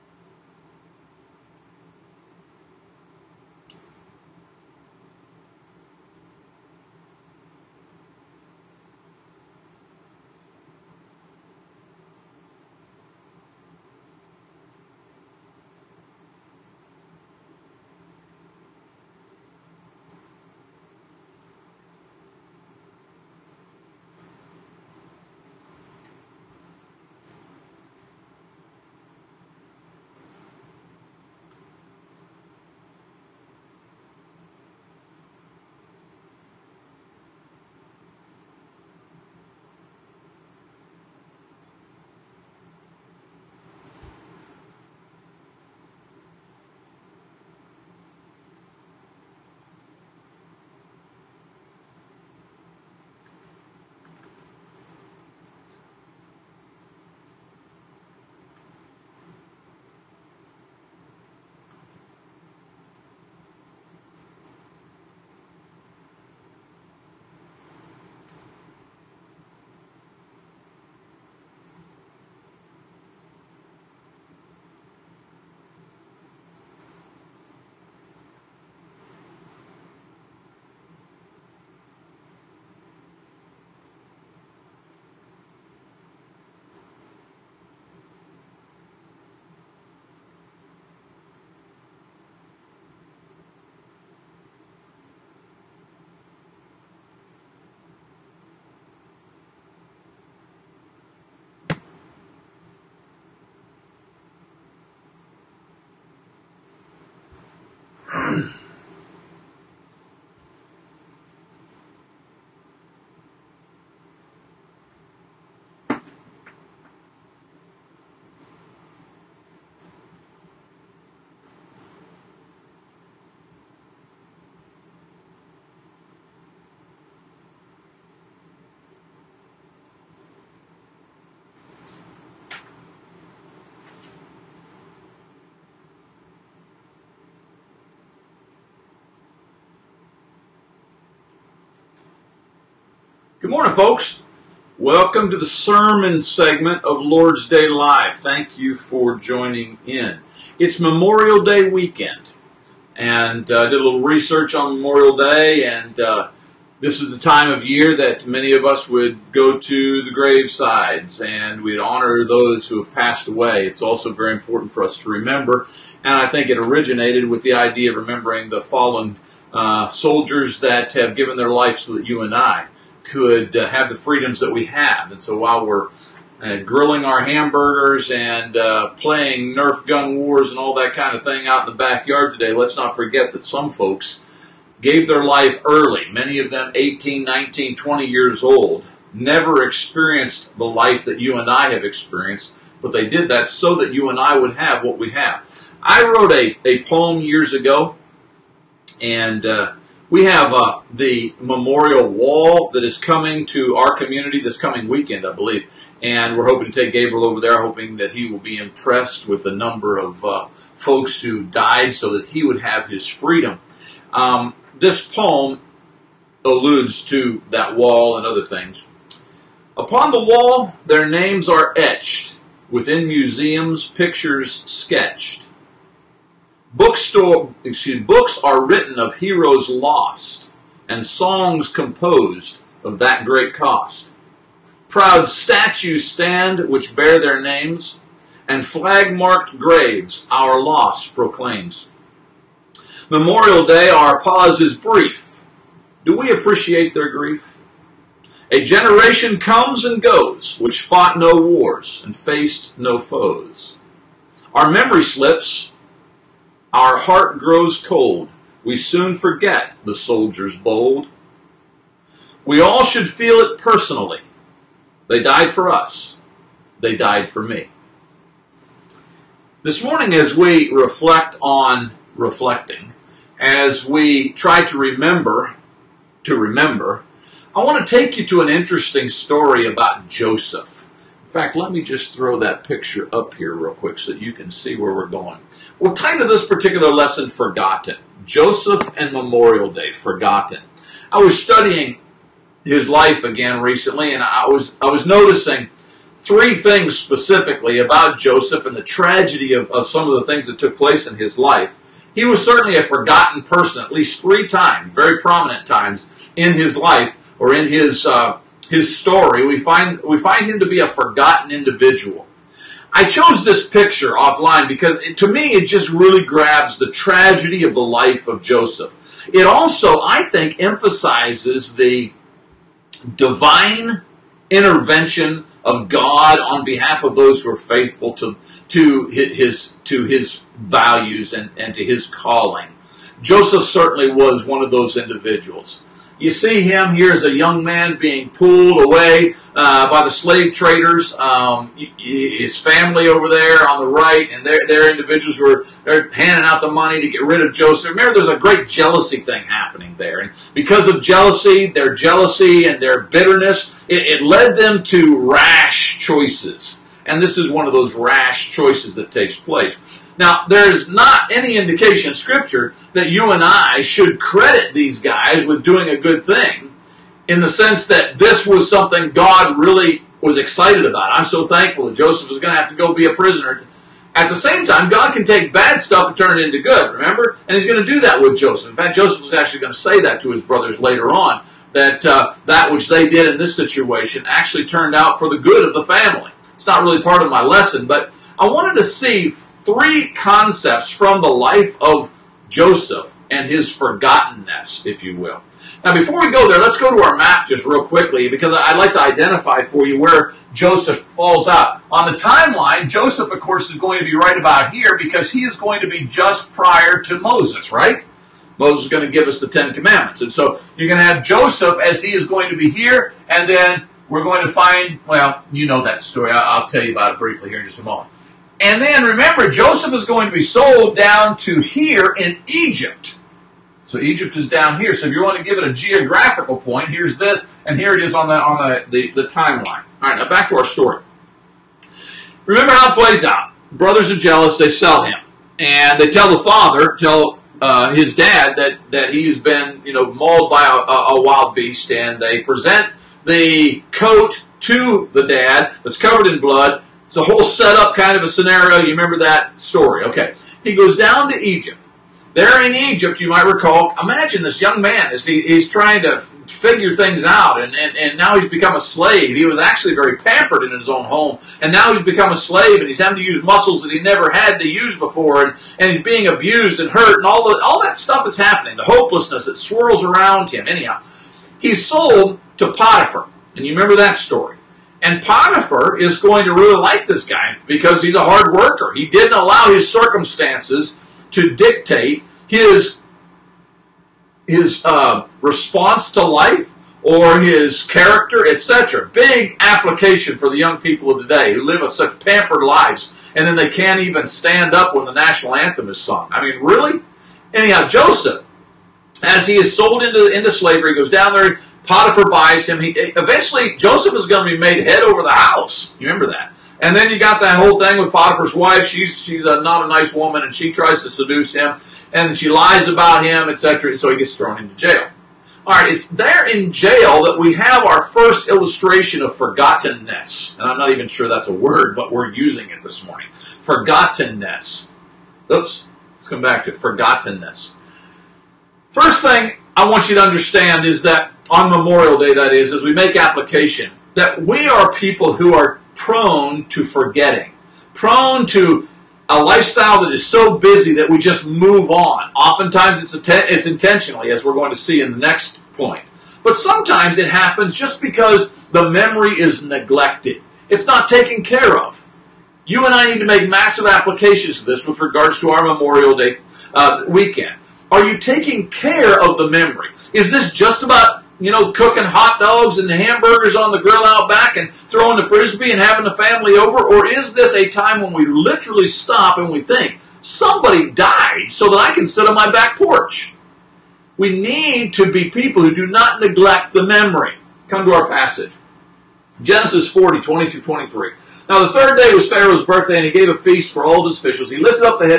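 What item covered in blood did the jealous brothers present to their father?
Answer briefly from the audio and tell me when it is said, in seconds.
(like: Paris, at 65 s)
the coat, at 443 s.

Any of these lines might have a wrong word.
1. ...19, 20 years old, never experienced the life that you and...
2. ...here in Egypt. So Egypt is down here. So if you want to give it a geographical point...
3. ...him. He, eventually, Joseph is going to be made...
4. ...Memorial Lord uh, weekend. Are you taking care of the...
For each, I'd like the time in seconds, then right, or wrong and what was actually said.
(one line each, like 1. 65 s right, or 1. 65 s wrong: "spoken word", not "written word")
1. 187 s right
2. 421 s right
3. 502 s right
4. 555 s wrong: "Day", not "Lord".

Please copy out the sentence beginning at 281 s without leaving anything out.
In fact, let me just throw that picture up here real quick so that you can see where we're going.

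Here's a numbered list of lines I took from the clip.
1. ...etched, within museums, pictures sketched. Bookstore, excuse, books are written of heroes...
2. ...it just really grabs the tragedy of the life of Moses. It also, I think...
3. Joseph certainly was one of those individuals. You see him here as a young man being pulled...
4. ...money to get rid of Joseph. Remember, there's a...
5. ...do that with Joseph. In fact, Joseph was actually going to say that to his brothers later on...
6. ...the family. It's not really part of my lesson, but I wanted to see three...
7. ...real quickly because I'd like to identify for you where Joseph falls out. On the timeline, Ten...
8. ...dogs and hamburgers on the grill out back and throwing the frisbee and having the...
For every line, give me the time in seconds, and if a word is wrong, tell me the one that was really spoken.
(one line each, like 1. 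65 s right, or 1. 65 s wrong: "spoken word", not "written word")
1. 221 s right
2. 315 s wrong: "Joseph", not "Moses"
3. 333 s right
4. 346 s right
5. 377 s right
6. 385 s right
7. 397 s wrong: "Joseph", not "Ten"
8. 562 s right.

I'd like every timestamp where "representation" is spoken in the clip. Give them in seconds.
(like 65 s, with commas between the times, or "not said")
not said.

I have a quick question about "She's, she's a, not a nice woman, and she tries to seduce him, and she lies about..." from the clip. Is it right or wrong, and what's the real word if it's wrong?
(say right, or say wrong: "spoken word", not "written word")
right.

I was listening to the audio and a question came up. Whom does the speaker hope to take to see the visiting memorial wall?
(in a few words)
Gabriel.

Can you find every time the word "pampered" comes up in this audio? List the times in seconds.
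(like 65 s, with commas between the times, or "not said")
460 s, 492 s.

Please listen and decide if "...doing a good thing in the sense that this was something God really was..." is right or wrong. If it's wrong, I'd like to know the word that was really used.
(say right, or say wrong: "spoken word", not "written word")
right.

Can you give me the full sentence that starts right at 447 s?
It's a whole setup kind of a scenario.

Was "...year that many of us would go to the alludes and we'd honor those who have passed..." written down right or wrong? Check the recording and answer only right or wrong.
wrong.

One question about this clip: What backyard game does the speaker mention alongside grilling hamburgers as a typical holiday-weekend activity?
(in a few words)
Nerf gun wars.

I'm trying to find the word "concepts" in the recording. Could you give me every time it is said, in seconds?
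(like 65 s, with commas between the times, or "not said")
390 s.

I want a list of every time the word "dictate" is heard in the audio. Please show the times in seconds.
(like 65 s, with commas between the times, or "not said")
481 s.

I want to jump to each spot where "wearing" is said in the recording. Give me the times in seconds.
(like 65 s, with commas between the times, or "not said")
not said.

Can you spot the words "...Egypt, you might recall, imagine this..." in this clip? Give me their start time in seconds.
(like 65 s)
452 s.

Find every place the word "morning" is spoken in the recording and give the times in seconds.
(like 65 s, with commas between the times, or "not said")
143 s, 269 s, 523 s.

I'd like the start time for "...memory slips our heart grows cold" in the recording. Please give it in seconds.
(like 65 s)
254 s.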